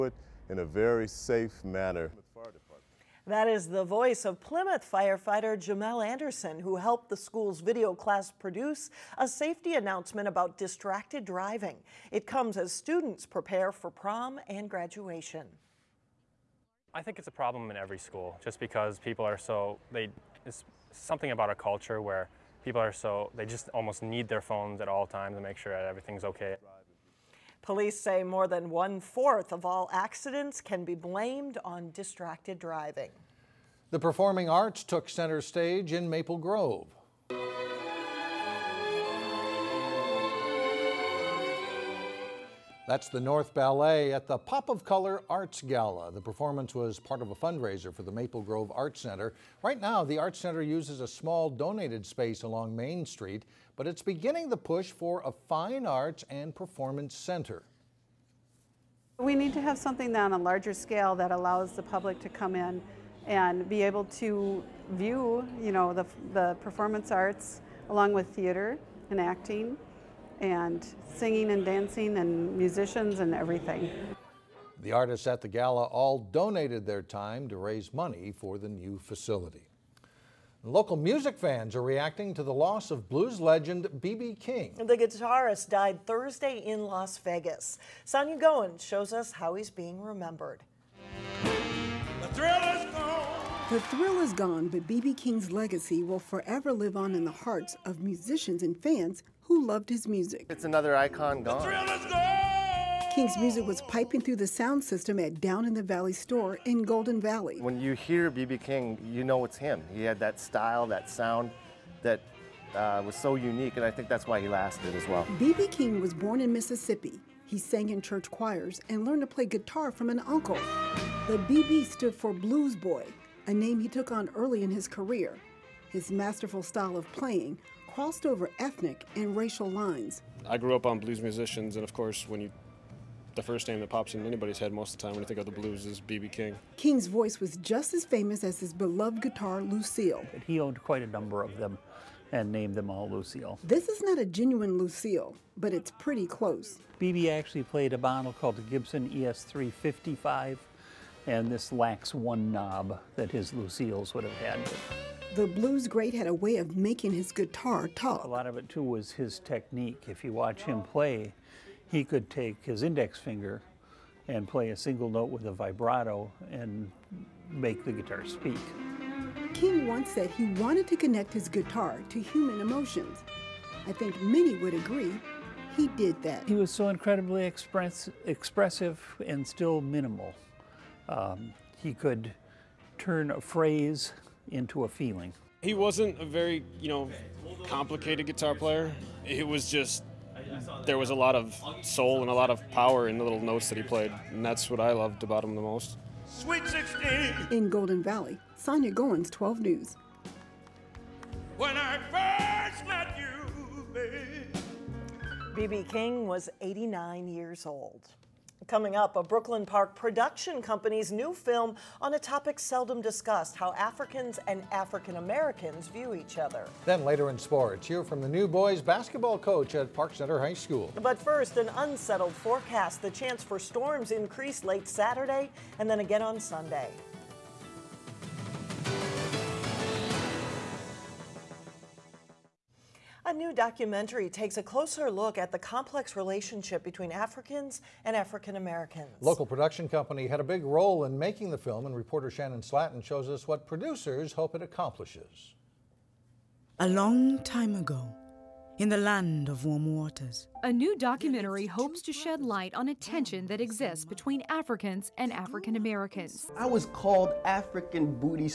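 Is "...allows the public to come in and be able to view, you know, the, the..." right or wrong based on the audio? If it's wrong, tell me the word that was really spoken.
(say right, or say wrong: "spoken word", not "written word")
right.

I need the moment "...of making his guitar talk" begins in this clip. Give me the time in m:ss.
2:36.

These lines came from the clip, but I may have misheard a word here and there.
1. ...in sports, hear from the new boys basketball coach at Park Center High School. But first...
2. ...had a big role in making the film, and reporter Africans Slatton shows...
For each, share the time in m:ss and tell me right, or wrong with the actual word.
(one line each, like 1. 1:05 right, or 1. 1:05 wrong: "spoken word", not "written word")
1. 3:37 right
2. 4:00 wrong: "Shannon", not "Africans".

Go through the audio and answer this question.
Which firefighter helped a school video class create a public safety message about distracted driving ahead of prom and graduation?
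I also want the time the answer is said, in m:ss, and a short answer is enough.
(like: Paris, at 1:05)
Jamel Anderson, at 0:05.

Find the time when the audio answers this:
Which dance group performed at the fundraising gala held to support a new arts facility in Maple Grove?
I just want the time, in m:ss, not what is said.
0:43.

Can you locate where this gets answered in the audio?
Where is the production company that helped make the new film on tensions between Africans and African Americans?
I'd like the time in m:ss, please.
3:29.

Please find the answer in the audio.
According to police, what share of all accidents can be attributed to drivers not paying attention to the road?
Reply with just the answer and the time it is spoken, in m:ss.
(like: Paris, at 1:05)
more than one fourth, at 0:28.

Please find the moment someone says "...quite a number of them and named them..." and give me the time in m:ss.
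2:20.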